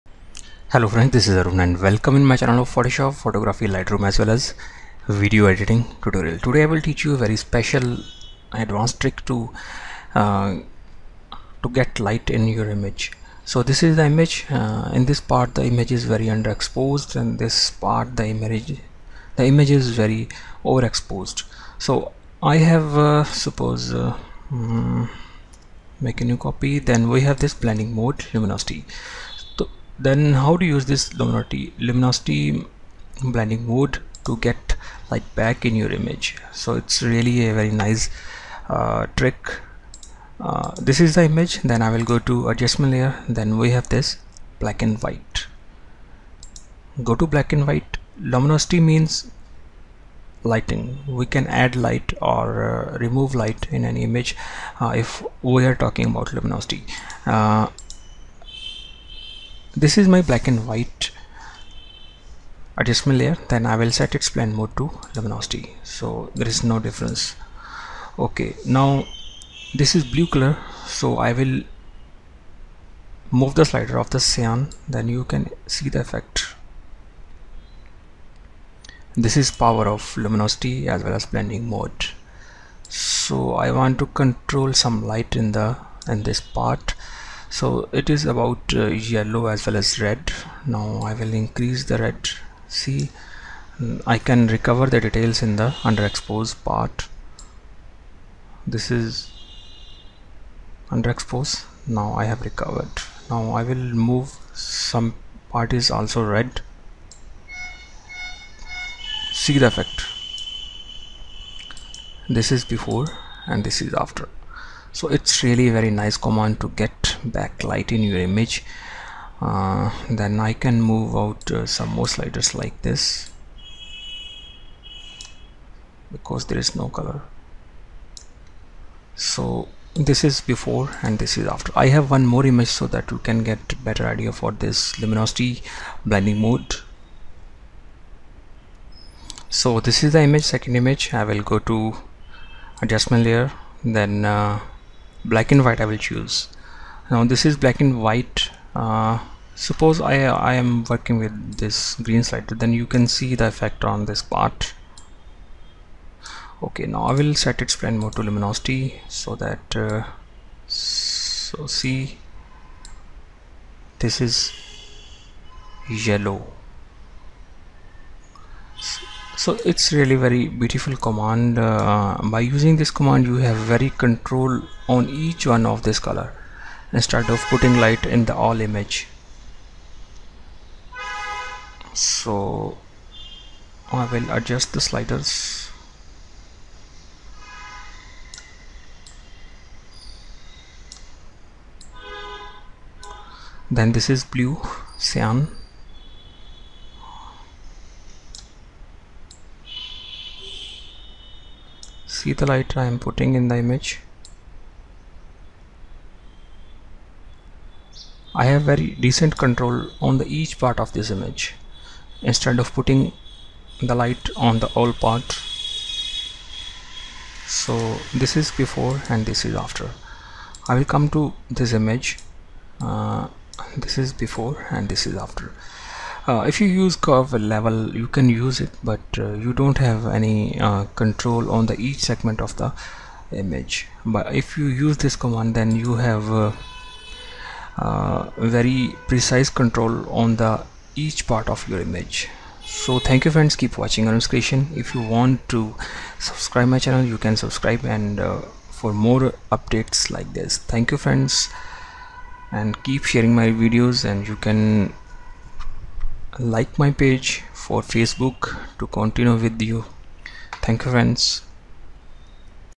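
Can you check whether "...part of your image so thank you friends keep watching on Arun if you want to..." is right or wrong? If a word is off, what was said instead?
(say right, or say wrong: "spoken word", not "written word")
wrong: "Creation", not "Arun".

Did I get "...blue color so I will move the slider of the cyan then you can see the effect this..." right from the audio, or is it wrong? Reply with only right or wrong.
right.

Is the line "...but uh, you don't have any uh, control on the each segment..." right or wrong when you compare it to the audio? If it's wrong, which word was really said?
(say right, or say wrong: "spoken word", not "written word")
right.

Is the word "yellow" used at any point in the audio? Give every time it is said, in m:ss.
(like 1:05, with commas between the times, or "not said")
1:28, 2:45.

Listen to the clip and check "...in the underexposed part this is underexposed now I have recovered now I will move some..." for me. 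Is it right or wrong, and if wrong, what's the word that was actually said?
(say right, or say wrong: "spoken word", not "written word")
right.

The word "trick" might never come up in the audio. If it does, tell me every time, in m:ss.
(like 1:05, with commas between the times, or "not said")
0:09, 0:39.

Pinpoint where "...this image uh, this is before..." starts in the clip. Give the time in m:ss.
3:41.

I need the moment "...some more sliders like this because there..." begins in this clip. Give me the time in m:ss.
2:01.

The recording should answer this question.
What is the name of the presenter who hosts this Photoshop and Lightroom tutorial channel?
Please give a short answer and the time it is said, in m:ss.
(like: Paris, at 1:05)
Arun, at 0:01.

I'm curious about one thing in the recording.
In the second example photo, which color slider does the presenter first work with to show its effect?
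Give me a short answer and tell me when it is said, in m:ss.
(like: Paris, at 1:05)
Green, at 2:31.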